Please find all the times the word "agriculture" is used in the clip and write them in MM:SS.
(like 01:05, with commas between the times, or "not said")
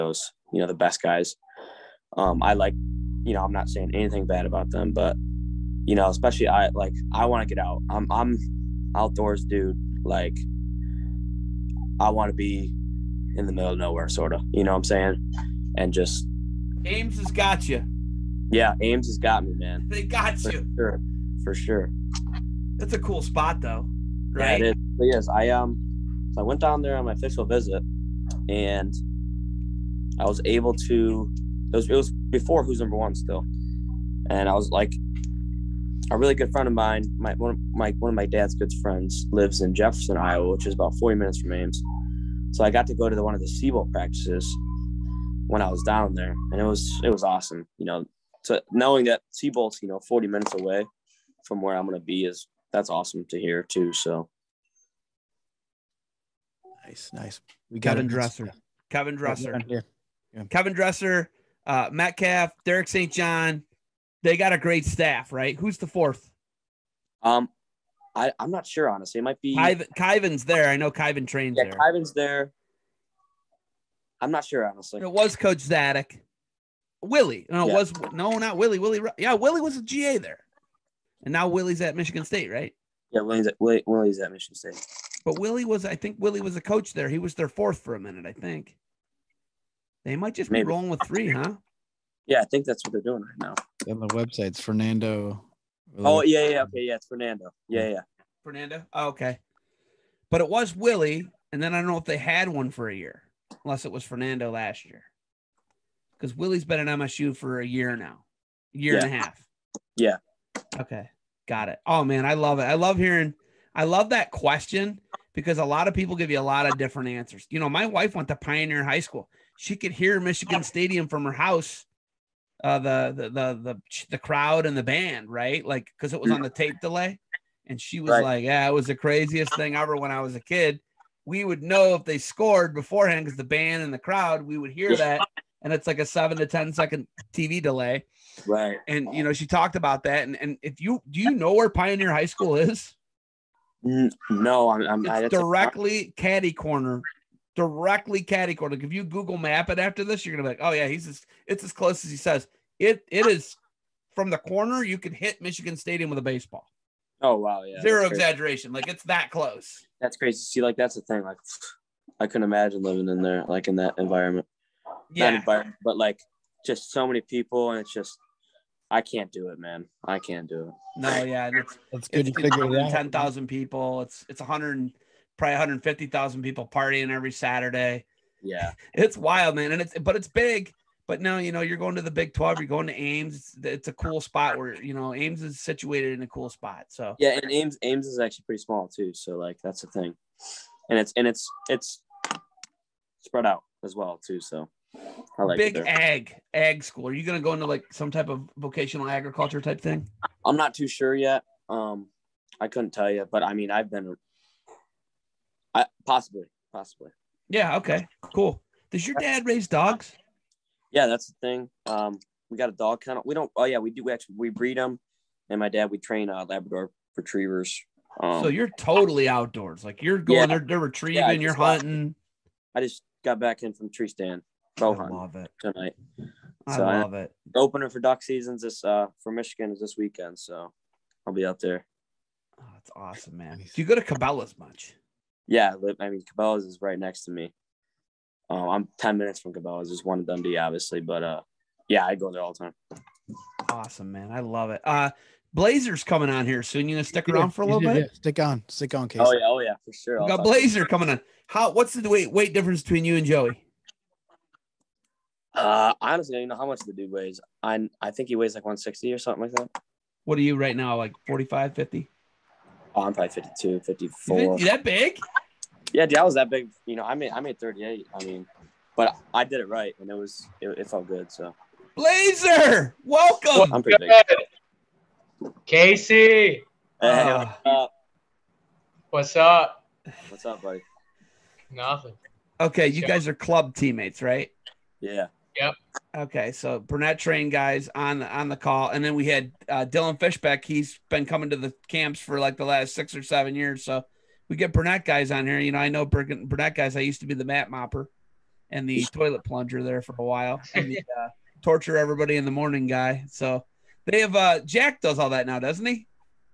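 03:19.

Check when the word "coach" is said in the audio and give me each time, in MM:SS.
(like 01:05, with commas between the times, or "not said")
01:15, 01:26.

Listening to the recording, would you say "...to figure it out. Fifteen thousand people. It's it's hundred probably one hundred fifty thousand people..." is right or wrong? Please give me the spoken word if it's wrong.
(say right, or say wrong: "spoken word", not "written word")
wrong: "Ten", not "Fifteen".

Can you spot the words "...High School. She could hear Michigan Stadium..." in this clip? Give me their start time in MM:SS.
01:58.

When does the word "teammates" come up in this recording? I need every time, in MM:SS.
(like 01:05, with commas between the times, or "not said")
04:43.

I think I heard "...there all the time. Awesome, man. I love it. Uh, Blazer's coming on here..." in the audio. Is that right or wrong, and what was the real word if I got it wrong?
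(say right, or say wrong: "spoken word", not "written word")
right.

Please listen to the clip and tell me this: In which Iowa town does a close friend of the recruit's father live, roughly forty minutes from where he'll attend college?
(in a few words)
Jefferson.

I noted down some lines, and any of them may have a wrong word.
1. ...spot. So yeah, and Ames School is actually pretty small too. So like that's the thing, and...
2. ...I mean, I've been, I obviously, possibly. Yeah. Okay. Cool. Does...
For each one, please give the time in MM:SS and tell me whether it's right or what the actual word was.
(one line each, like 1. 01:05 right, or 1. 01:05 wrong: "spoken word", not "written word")
1. 03:06 wrong: "Ames", not "School"
2. 03:23 wrong: "possibly", not "obviously".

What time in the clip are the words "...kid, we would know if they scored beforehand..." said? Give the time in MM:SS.
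02:10.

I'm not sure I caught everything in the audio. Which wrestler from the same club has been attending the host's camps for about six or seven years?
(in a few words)
Dylan Fishback.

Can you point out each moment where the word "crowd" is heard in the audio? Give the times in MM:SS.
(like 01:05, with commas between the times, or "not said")
02:04, 02:13.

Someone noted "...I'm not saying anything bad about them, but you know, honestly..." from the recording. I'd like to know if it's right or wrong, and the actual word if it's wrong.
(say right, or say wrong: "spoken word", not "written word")
wrong: "especially", not "honestly".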